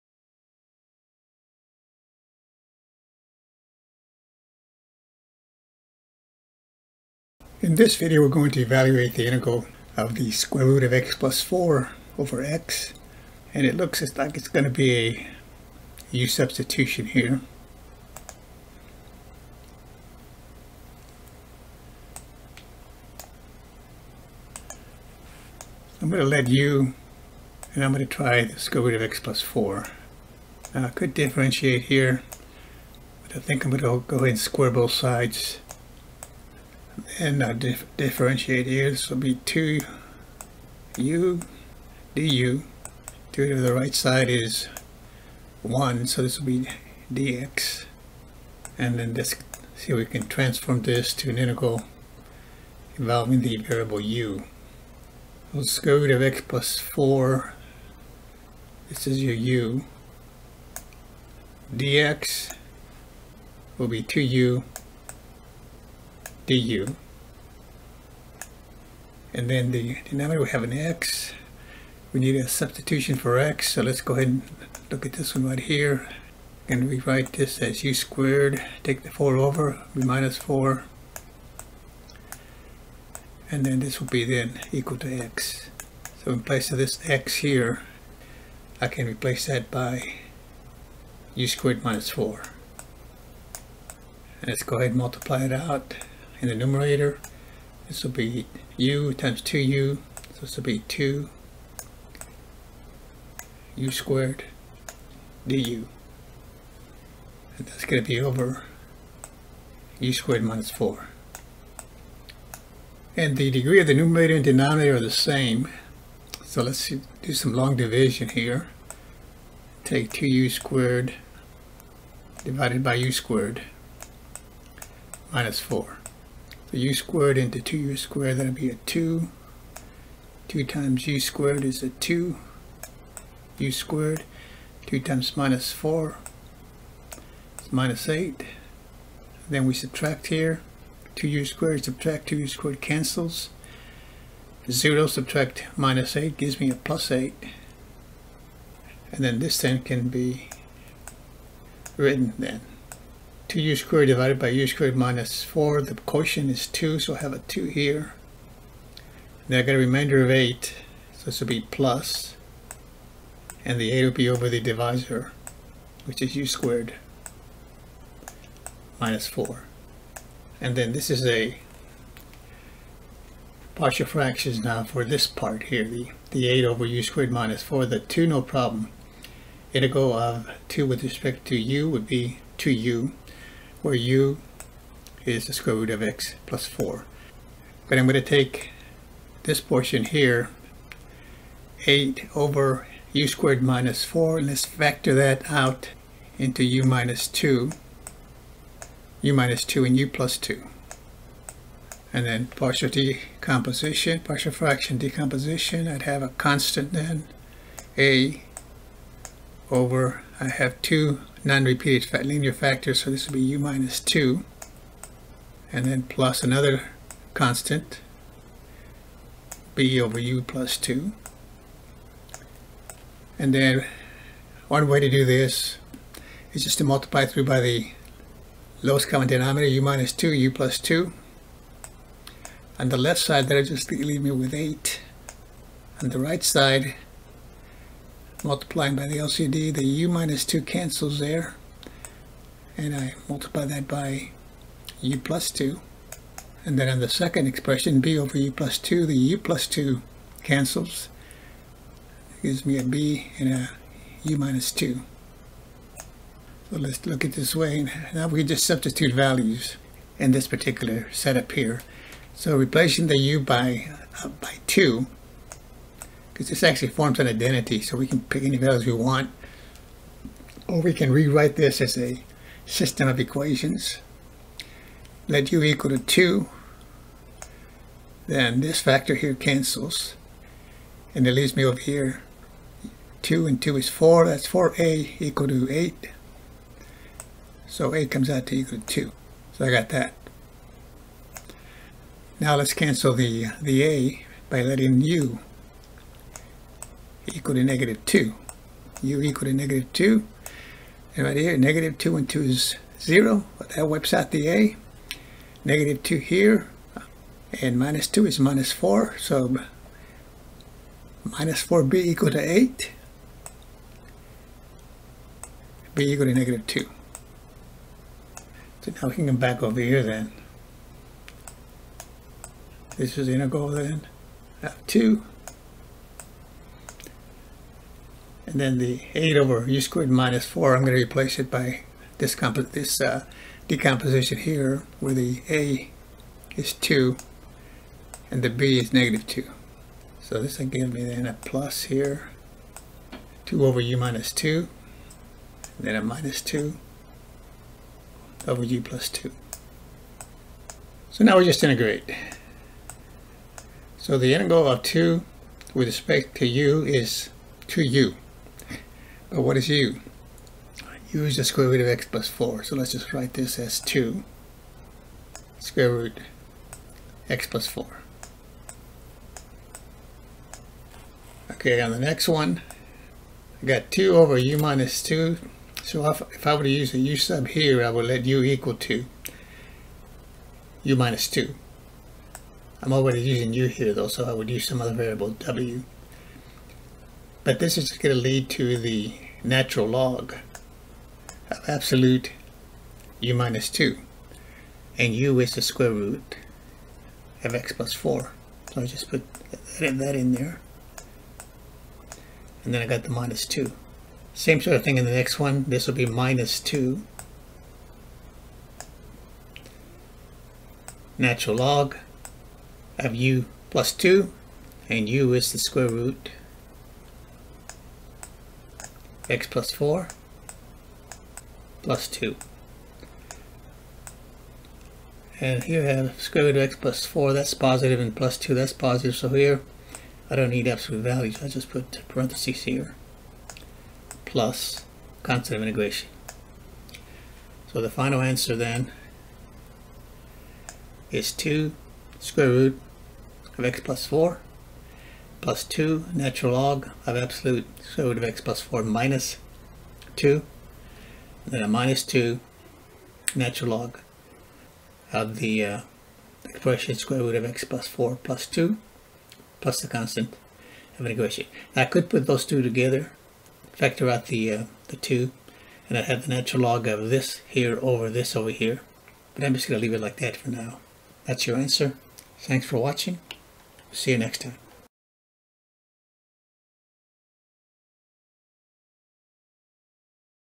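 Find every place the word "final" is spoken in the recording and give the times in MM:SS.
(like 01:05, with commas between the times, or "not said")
07:17.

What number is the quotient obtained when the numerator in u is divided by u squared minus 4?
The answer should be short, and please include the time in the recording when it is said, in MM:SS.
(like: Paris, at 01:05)
2, at 02:35.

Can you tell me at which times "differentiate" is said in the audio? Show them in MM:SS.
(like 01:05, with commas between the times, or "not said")
00:31, 00:37.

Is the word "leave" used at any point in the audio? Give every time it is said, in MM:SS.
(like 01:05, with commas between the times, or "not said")
03:53, 04:41, 07:49.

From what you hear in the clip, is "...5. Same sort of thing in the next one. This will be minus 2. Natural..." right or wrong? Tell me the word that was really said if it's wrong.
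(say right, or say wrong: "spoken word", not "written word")
wrong: "2", not "5".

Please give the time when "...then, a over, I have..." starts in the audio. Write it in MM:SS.
03:26.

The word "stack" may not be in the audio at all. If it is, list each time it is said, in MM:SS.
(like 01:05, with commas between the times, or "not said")
not said.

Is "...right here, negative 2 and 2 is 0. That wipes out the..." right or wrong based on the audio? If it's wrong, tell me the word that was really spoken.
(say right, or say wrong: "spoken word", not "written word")
right.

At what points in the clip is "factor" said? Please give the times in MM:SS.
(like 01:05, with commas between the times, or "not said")
03:14, 03:32, 04:38, 07:43.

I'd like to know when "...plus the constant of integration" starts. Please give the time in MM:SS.
07:39.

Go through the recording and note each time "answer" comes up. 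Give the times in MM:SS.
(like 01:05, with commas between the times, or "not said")
07:18, 07:51.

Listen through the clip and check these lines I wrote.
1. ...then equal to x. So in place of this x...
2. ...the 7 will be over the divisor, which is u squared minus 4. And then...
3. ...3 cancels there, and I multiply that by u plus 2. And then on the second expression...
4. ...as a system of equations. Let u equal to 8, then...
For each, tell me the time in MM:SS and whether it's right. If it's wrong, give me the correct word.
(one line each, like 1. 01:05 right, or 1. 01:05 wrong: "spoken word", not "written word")
1. 01:24 right
2. 02:43 wrong: "8", not "7"
3. 04:00 wrong: "2", not "3"
4. 04:31 wrong: "2", not "8".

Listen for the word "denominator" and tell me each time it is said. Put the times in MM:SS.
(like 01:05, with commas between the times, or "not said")
01:10, 01:54, 03:49.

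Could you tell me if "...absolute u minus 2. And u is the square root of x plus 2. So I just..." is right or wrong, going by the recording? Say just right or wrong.
wrong.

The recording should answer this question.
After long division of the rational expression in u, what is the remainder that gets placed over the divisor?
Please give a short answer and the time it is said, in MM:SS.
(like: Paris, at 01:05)
8, at 02:39.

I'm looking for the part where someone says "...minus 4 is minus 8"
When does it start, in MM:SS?
02:15.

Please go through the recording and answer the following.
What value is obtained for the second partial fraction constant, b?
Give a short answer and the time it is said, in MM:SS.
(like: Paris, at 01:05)
-2, at 05:15.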